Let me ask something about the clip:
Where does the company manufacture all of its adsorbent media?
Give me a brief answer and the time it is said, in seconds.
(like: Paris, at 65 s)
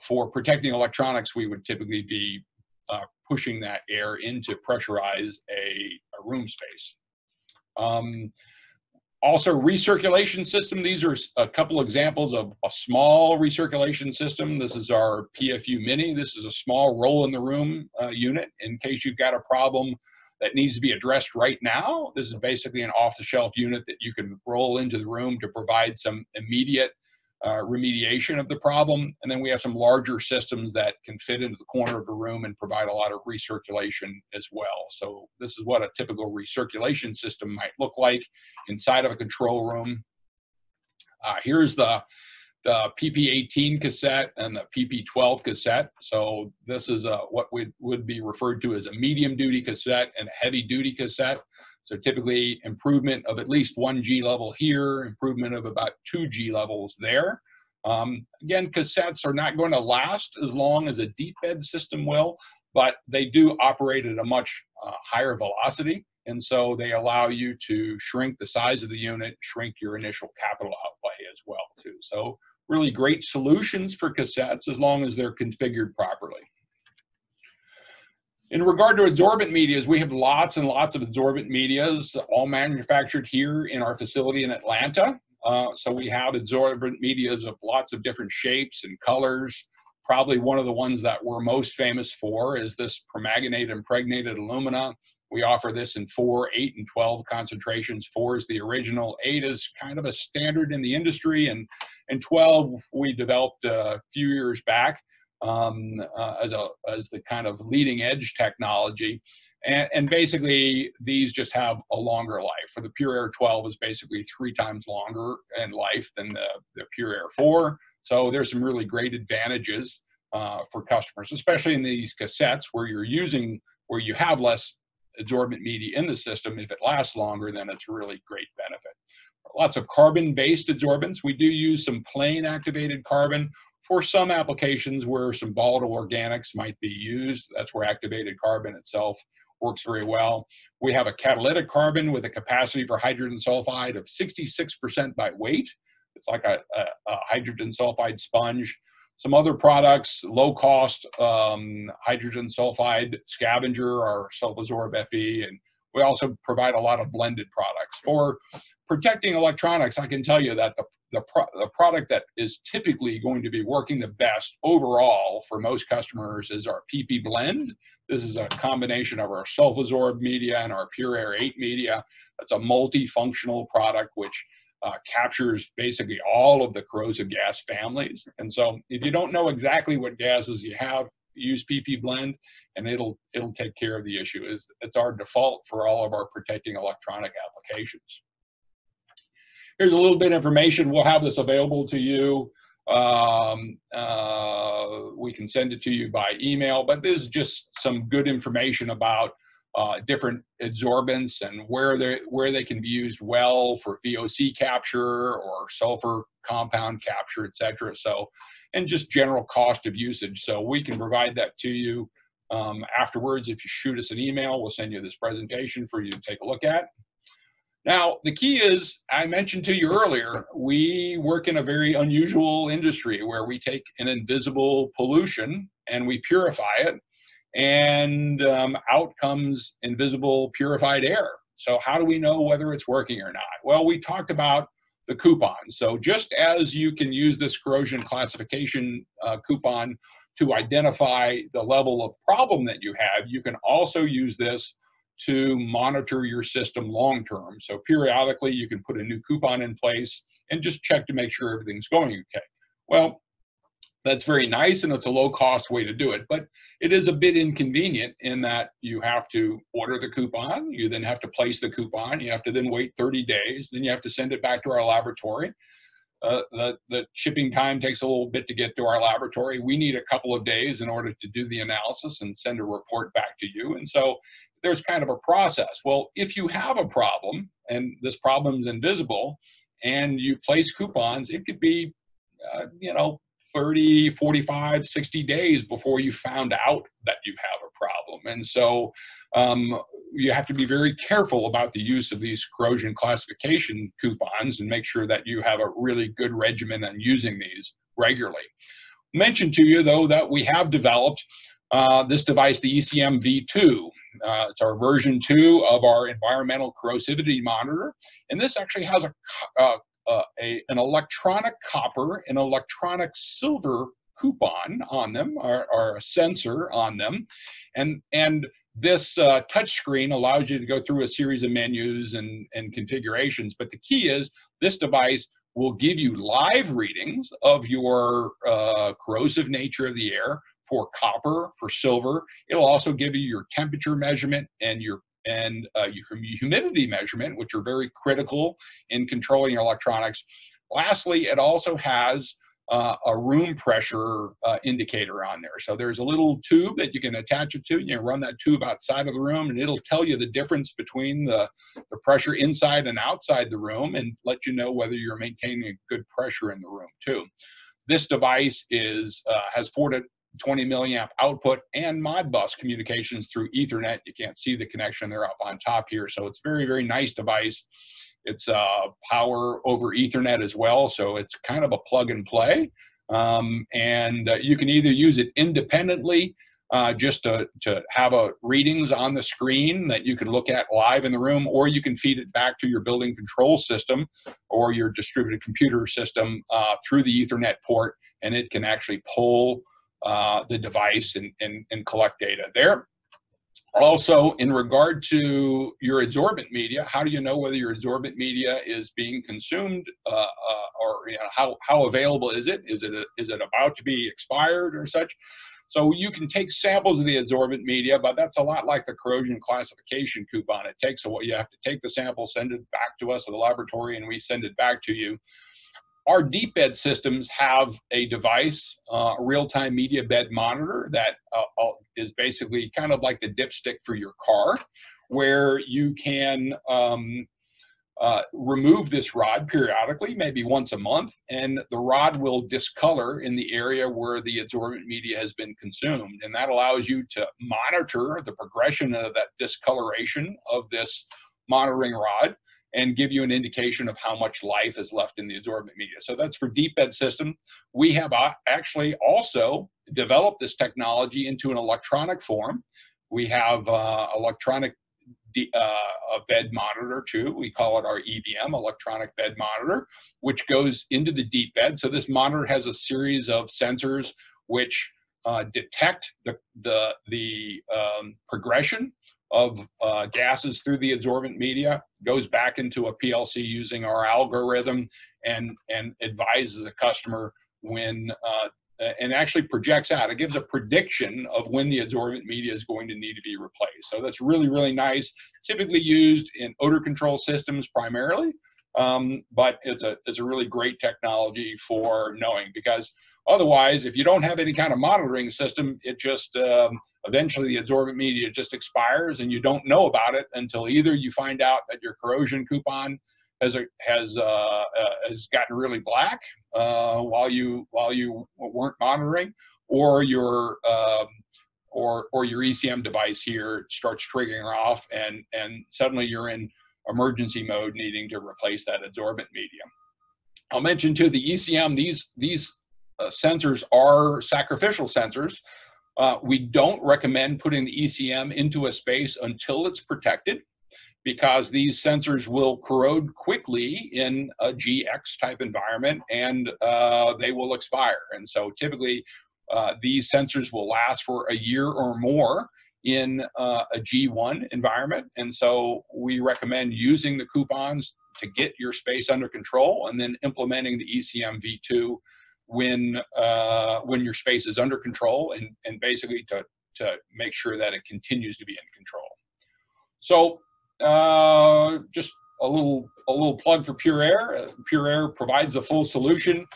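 Atlanta, at 84 s.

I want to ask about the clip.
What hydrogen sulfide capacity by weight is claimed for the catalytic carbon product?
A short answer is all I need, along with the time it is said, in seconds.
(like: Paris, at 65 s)
66%, at 144 s.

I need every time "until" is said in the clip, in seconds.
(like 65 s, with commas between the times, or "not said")
500 s, 529 s.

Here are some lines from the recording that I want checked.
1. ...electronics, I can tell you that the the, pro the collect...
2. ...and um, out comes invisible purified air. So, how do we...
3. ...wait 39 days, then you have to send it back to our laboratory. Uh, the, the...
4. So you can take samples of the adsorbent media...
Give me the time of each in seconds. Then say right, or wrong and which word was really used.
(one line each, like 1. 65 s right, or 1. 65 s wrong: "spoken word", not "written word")
1. 159 s wrong: "product", not "collect"
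2. 227 s right
3. 262 s wrong: "30", not "39"
4. 405 s right.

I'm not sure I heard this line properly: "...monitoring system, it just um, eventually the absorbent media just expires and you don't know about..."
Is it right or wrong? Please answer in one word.
right.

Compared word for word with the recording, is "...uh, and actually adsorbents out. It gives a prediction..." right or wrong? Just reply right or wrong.
wrong.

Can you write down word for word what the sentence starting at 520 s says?
I'll mention to the ECM these these uh, sensors are sacrificial sensors.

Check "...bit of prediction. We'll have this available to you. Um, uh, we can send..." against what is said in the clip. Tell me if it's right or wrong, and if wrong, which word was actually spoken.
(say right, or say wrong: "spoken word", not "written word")
wrong: "information", not "prediction".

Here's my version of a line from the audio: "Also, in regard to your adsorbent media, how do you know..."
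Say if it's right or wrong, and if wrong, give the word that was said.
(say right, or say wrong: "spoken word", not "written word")
right.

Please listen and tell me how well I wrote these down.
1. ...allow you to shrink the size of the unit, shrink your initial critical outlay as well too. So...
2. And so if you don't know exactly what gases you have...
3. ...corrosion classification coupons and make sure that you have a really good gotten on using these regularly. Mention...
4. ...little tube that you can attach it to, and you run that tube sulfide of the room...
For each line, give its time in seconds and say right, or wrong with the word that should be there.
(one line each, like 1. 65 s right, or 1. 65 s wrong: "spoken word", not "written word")
1. 66 s wrong: "capital", not "critical"
2. 178 s right
3. 292 s wrong: "regimen", not "gotten"
4. 346 s wrong: "outside", not "sulfide".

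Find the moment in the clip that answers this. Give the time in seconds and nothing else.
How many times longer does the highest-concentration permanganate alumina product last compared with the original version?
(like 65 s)
114 s.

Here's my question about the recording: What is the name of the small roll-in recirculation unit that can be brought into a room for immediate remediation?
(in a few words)
PFU Mini.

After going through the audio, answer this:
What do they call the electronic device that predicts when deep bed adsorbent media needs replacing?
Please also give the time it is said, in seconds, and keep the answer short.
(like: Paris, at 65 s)
electronic bed monitor, at 458 s.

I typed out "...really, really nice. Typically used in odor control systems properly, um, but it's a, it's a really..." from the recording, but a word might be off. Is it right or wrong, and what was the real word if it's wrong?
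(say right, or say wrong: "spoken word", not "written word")
wrong: "primarily", not "properly".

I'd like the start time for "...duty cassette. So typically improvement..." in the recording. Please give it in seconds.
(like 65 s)
50 s.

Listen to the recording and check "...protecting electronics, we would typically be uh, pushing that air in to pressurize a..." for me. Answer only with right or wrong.
right.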